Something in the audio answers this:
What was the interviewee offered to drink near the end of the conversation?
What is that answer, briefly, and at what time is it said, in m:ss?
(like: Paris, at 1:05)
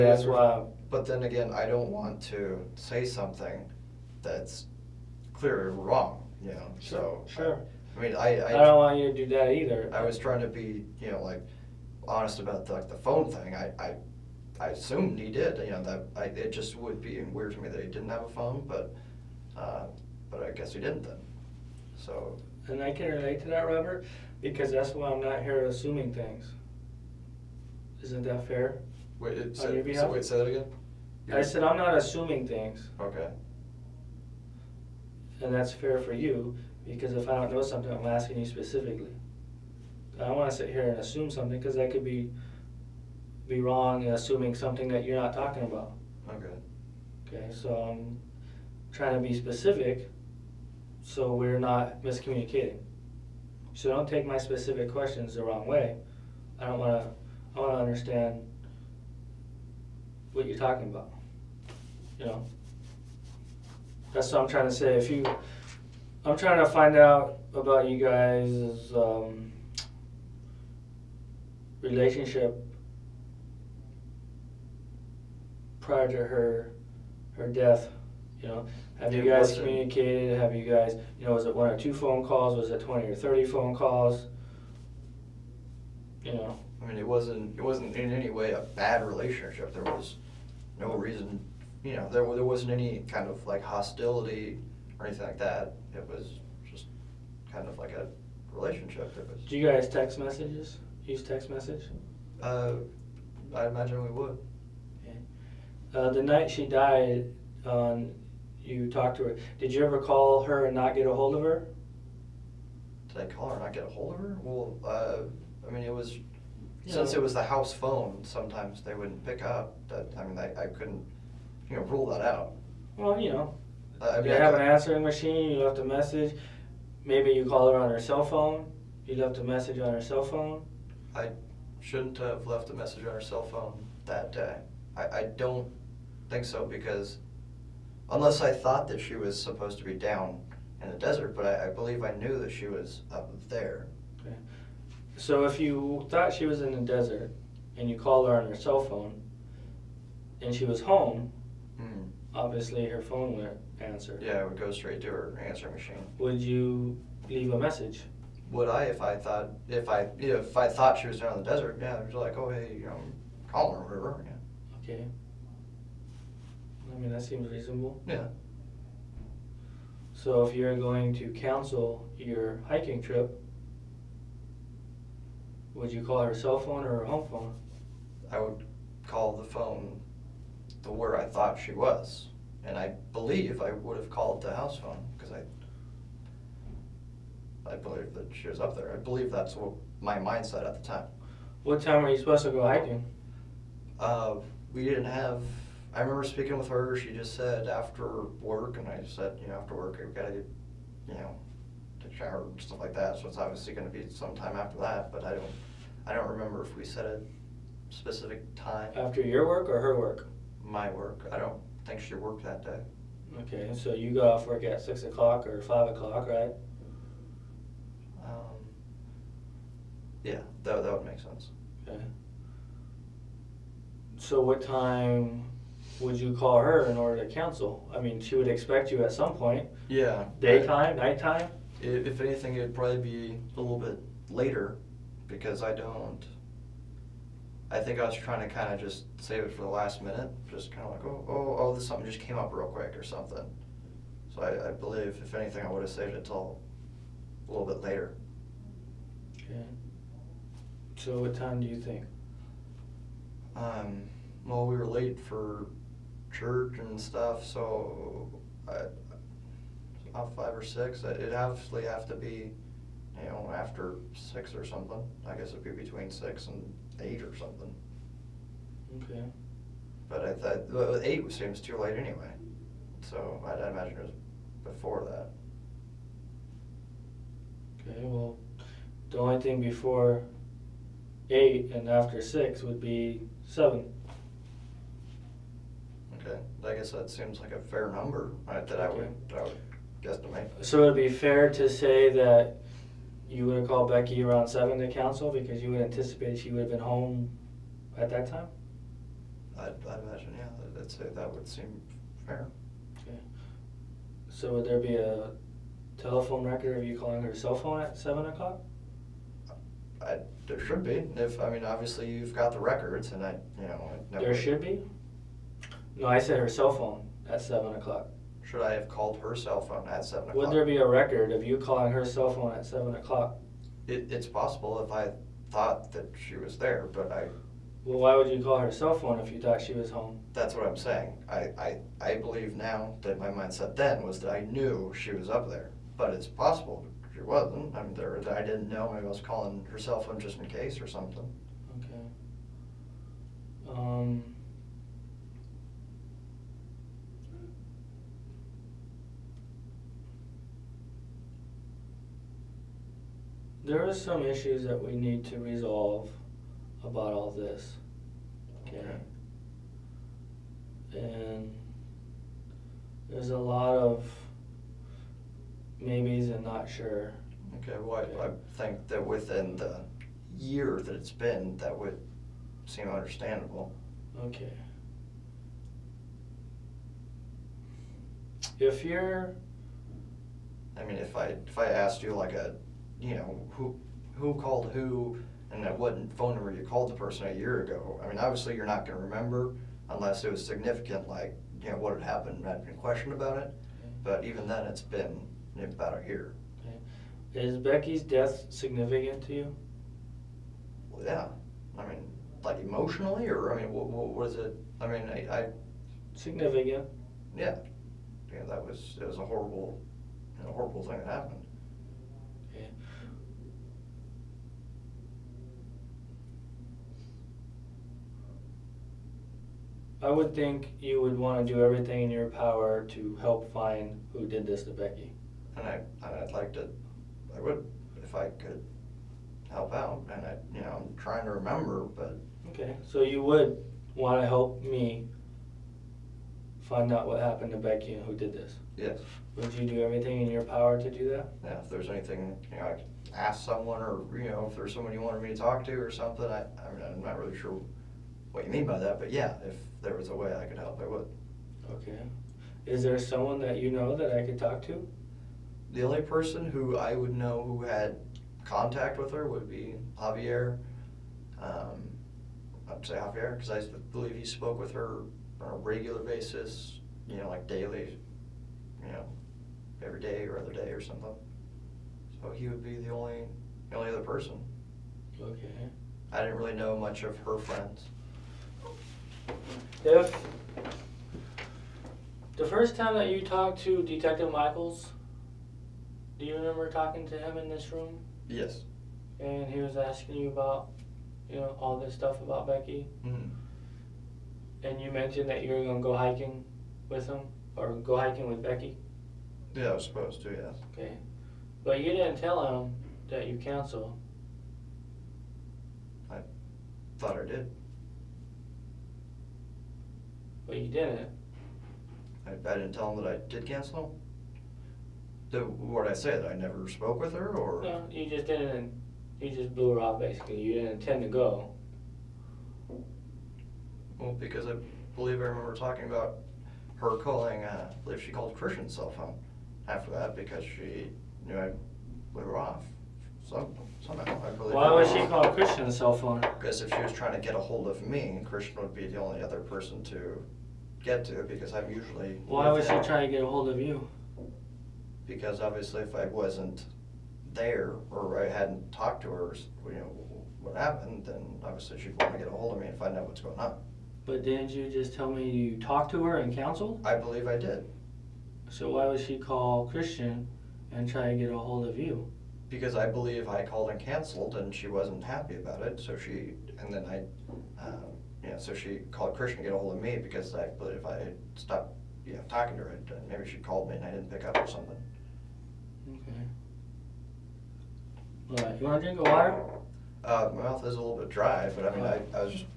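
water, at 9:39.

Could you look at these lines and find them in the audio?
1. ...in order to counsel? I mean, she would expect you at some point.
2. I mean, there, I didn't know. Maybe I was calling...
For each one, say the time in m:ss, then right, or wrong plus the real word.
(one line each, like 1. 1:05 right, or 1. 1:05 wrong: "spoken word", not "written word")
1. 3:46 right
2. 5:37 right.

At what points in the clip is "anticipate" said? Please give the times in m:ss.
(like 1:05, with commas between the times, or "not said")
4:55.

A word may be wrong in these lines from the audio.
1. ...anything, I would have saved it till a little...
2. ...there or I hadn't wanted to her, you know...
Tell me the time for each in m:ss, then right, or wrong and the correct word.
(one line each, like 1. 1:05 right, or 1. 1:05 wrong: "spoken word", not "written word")
1. 4:05 right
2. 9:07 wrong: "talked", not "wanted".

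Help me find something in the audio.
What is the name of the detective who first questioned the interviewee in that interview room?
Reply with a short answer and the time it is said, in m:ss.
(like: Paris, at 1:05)
Detective Michaels, at 8:03.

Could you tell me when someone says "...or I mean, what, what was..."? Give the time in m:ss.
6:43.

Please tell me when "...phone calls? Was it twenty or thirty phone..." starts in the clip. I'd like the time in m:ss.
1:21.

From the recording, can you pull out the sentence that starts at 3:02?
And I believe I would have called the house phone because I I believe that she was up there.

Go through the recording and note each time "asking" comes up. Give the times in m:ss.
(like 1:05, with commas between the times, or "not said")
0:38, 8:09.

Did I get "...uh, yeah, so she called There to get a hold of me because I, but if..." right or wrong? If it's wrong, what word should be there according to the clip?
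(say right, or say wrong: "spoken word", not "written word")
wrong: "Christian", not "There".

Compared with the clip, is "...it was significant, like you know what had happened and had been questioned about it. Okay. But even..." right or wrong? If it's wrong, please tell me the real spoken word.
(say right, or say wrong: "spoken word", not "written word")
right.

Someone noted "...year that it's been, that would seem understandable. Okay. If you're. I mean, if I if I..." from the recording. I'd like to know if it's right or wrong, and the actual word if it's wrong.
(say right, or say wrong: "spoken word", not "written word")
right.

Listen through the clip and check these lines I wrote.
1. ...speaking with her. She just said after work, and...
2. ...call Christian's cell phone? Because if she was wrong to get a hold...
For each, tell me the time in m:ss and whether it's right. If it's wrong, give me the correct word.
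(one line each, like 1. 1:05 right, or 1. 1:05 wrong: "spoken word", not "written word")
1. 3:16 right
2. 8:55 wrong: "trying", not "wrong".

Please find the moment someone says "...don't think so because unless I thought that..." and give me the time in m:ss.
2:15.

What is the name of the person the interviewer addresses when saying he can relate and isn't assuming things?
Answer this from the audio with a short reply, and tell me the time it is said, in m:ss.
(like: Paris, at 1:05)
Robert, at 0:23.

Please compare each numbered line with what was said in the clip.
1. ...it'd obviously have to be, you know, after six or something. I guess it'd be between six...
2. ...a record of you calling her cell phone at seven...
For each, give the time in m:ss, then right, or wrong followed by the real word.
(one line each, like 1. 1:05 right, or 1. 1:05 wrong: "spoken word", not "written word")
1. 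4:21 right
2. 5:20 right.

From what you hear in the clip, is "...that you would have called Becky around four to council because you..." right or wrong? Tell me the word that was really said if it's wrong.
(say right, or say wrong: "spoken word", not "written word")
wrong: "seven", not "four".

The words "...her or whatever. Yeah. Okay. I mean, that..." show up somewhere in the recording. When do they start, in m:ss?
2:43.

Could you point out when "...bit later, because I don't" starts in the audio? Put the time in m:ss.
3:53.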